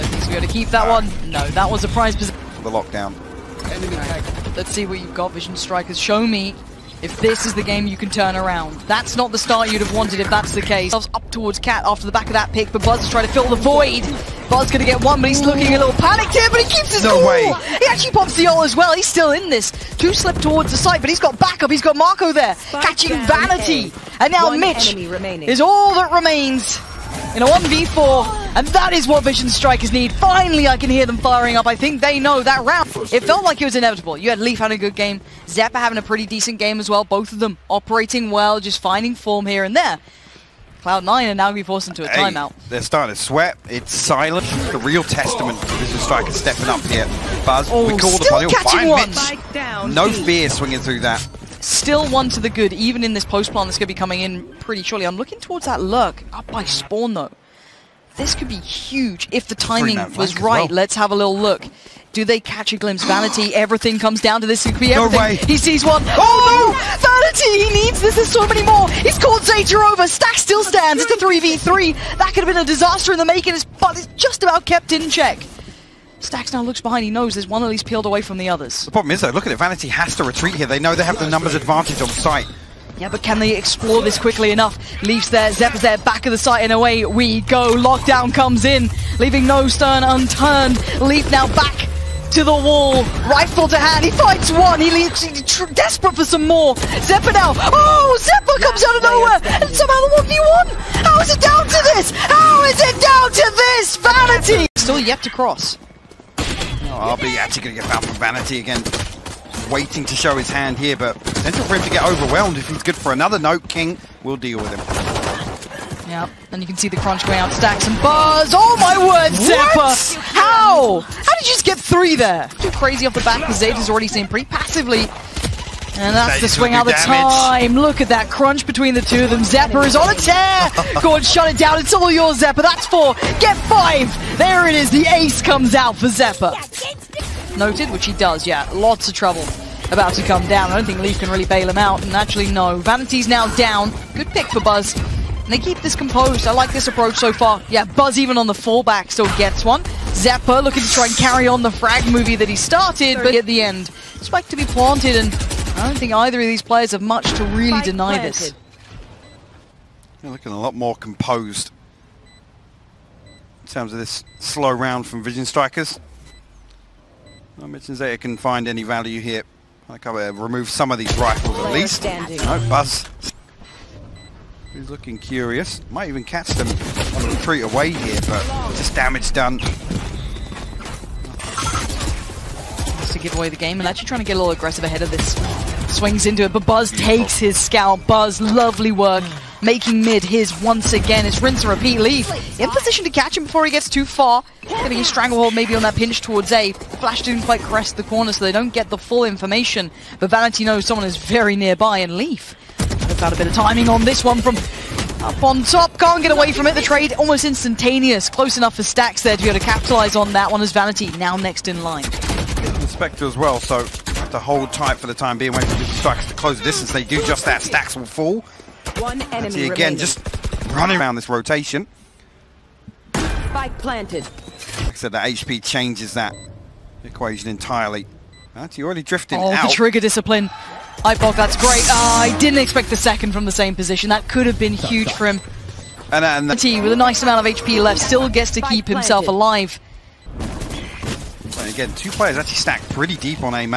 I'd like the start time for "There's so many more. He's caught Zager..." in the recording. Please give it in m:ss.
1:08.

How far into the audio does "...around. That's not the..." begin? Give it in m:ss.
0:08.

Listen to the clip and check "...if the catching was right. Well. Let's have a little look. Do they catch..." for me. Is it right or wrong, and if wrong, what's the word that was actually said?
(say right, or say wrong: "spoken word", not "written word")
wrong: "timing", not "catching".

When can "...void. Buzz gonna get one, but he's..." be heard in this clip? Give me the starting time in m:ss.
0:13.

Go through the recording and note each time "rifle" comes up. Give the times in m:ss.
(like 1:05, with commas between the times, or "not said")
1:33, 2:51.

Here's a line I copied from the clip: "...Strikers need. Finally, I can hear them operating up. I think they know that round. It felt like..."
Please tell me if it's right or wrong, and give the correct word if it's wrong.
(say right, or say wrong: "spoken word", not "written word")
wrong: "firing", not "operating".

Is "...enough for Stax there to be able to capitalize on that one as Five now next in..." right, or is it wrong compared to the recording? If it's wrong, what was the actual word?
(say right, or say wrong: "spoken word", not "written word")
wrong: "Vanity", not "Five".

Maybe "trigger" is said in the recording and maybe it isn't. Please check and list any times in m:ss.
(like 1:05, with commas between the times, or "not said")
3:49.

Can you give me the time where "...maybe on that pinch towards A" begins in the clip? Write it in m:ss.
3:15.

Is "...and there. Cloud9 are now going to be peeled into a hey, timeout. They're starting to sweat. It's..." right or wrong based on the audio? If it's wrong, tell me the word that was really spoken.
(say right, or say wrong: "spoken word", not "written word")
wrong: "forced", not "peeled".